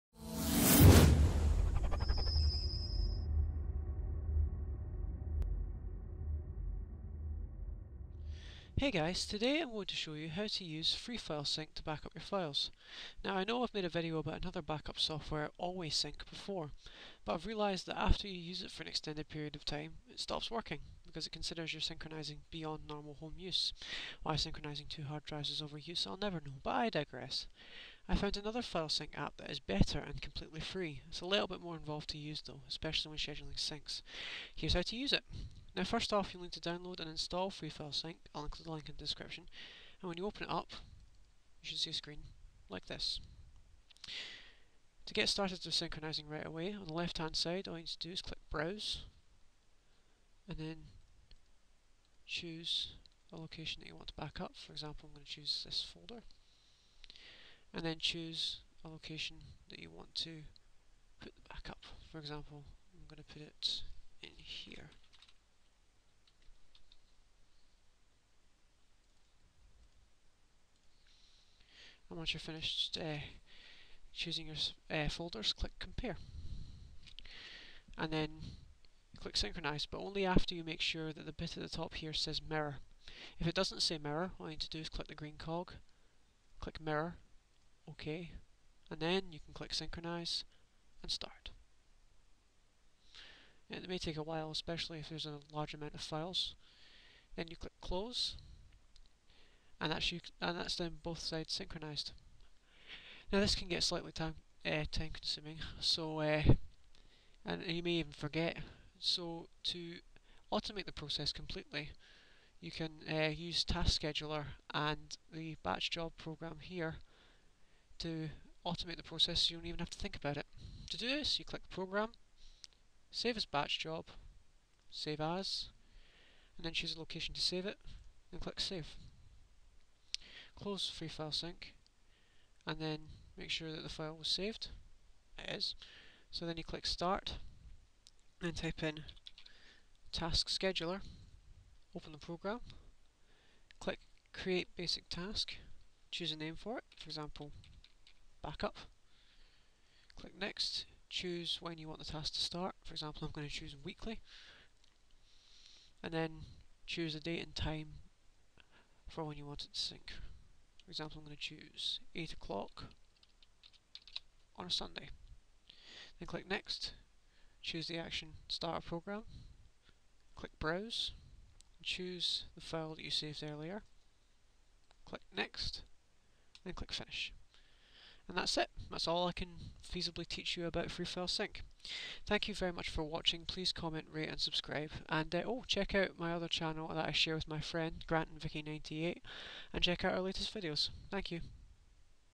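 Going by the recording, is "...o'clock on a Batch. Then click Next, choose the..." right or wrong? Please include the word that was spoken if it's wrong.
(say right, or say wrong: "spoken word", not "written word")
wrong: "Sunday", not "Batch".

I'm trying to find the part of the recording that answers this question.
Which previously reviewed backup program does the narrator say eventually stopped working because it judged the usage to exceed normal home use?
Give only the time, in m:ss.
0:15.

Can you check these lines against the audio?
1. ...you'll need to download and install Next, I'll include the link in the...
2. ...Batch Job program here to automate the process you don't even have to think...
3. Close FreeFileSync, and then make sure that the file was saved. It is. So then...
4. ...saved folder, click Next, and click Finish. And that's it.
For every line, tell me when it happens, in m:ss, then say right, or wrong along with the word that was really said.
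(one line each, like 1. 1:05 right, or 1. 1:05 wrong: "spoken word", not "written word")
1. 0:36 wrong: "FreeFileSync", not "Next"
2. 1:55 right
3. 2:10 right
4. 2:53 wrong: "earlier", not "folder".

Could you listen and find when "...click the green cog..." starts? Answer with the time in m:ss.
1:24.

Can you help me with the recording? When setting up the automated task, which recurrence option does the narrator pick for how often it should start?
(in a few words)
Weekly.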